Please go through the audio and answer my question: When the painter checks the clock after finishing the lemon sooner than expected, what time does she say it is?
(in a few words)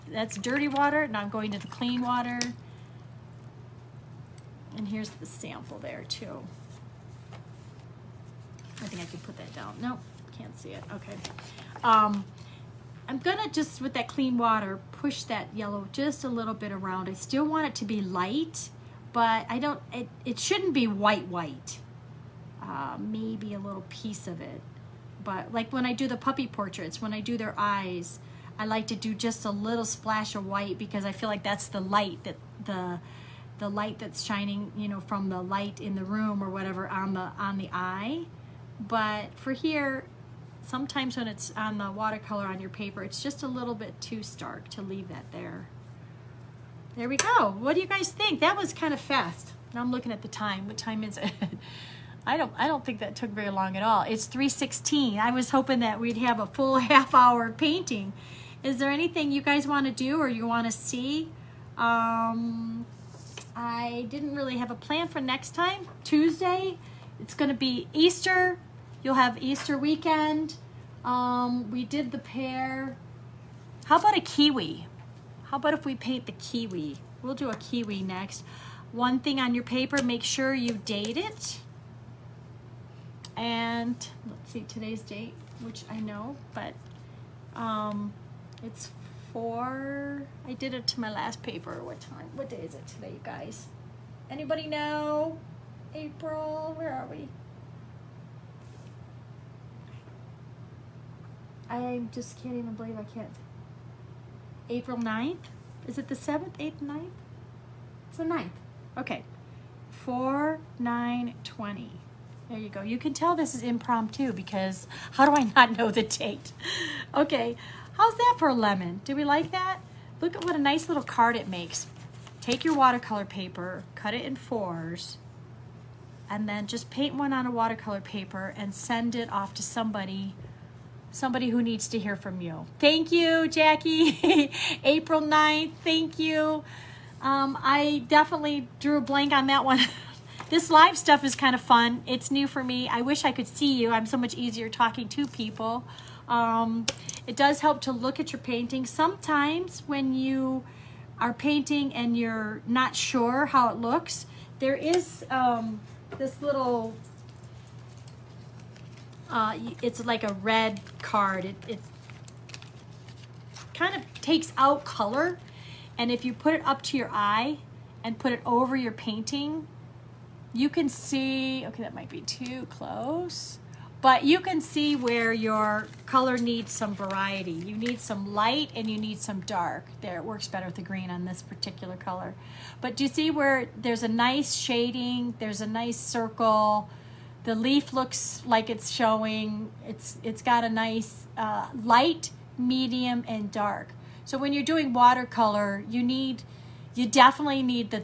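3:16.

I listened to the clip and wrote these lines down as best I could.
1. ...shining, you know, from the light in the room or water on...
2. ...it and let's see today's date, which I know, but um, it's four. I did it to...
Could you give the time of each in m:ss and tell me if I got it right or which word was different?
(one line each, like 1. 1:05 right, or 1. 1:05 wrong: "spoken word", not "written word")
1. 0:34 wrong: "whatever", not "water"
2. 1:21 right.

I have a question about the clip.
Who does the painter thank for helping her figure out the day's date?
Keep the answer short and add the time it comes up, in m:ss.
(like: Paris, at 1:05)
Jackie, at 2:12.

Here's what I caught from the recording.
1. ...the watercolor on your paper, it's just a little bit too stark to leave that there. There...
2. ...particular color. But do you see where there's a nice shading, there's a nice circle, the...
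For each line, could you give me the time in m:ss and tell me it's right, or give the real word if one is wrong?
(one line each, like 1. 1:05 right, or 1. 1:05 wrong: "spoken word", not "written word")
1. 0:41 right
2. 3:01 right.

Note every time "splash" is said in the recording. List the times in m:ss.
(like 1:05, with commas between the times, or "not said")
0:29.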